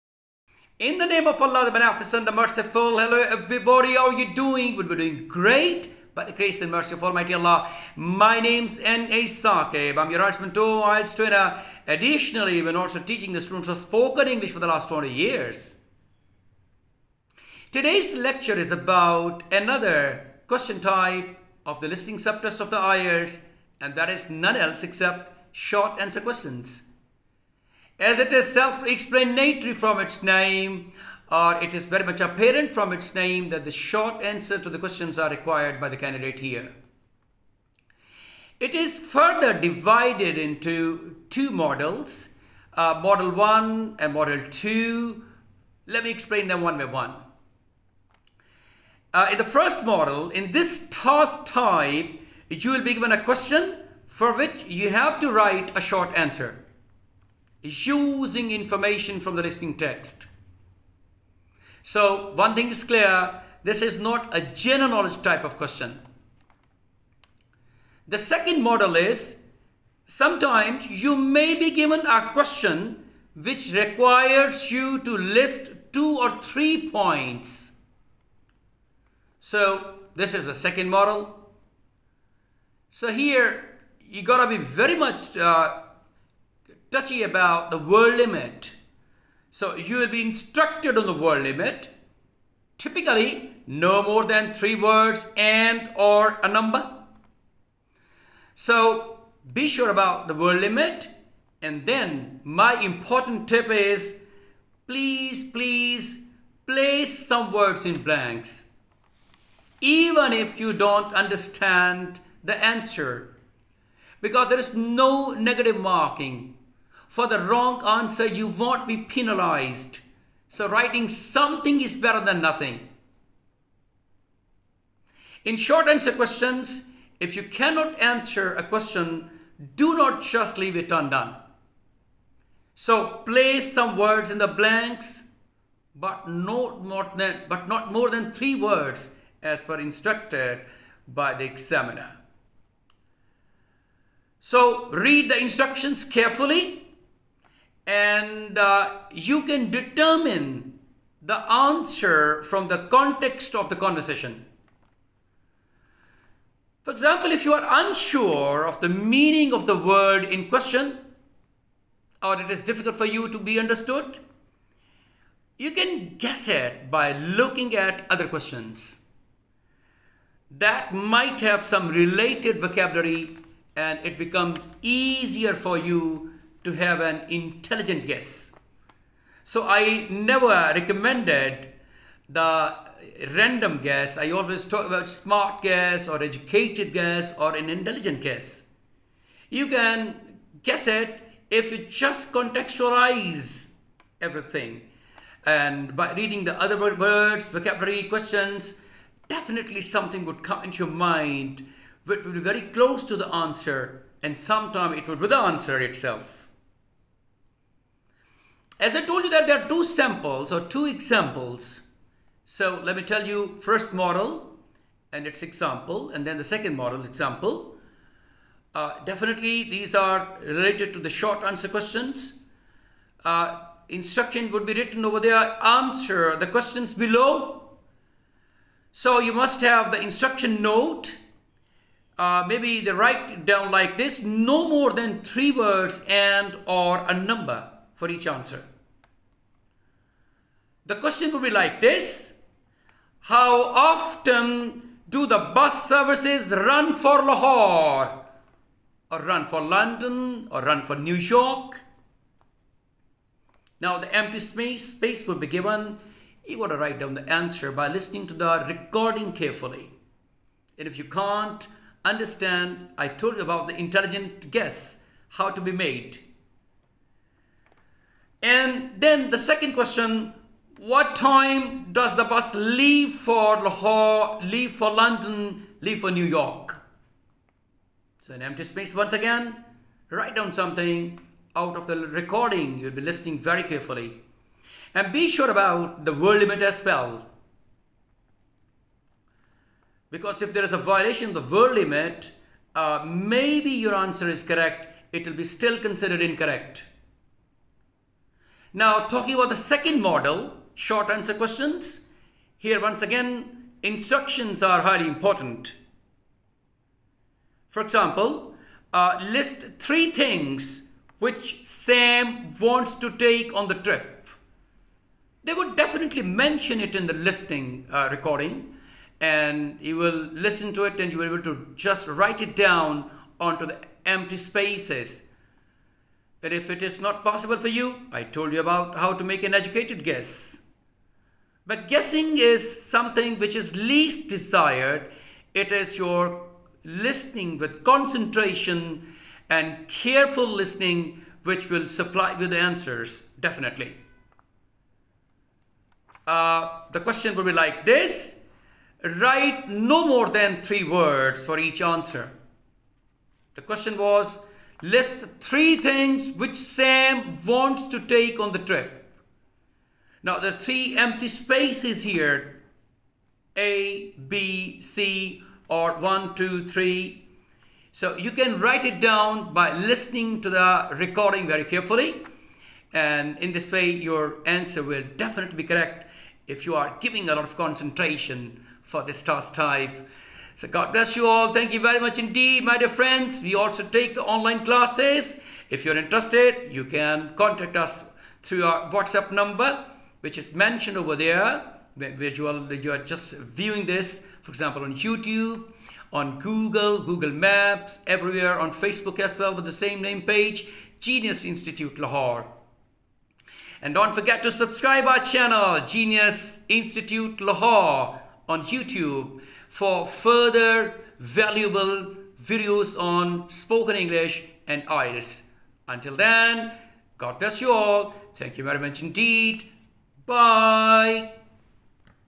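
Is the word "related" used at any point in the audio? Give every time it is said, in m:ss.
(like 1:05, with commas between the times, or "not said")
2:51, 3:40.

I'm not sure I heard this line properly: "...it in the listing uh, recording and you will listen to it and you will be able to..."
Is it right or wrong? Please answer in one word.
right.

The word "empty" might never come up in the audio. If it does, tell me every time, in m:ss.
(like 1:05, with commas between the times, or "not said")
4:14, 4:38, 5:24, 6:00.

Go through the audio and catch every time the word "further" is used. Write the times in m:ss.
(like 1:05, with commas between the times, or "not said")
0:38, 6:50.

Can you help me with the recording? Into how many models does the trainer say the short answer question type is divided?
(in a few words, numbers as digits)
2.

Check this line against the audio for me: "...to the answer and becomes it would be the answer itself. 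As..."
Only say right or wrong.
wrong.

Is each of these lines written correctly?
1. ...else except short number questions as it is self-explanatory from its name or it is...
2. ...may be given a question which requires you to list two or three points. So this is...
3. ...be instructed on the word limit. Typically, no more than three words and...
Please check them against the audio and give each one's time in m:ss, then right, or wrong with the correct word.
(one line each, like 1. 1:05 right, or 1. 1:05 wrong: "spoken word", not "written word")
1. 0:24 wrong: "answer", not "number"
2. 1:11 right
3. 1:30 right.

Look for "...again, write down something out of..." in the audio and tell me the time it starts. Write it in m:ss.
4:39.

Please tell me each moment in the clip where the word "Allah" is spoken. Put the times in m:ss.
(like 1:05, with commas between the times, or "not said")
0:01, 0:07.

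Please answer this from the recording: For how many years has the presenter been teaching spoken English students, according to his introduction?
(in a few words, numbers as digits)
20 years.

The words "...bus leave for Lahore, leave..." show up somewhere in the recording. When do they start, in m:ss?
4:32.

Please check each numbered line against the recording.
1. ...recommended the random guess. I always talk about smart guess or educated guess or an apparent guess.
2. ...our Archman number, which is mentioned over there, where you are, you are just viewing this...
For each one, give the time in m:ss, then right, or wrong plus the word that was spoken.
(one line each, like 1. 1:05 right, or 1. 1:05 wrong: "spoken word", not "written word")
1. 3:00 wrong: "intelligent", not "apparent"
2. 6:28 wrong: "WhatsApp", not "Archman".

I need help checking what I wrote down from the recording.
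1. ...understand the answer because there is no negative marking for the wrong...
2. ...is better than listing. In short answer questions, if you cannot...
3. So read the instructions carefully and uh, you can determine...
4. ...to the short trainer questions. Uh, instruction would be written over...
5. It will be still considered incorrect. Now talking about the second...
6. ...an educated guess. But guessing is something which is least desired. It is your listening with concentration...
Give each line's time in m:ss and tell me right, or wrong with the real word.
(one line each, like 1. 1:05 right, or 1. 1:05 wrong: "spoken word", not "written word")
1. 1:51 right
2. 2:01 wrong: "nothing", not "listing"
3. 2:24 right
4. 3:40 wrong: "answer", not "trainer"
5. 4:55 right
6. 5:29 right.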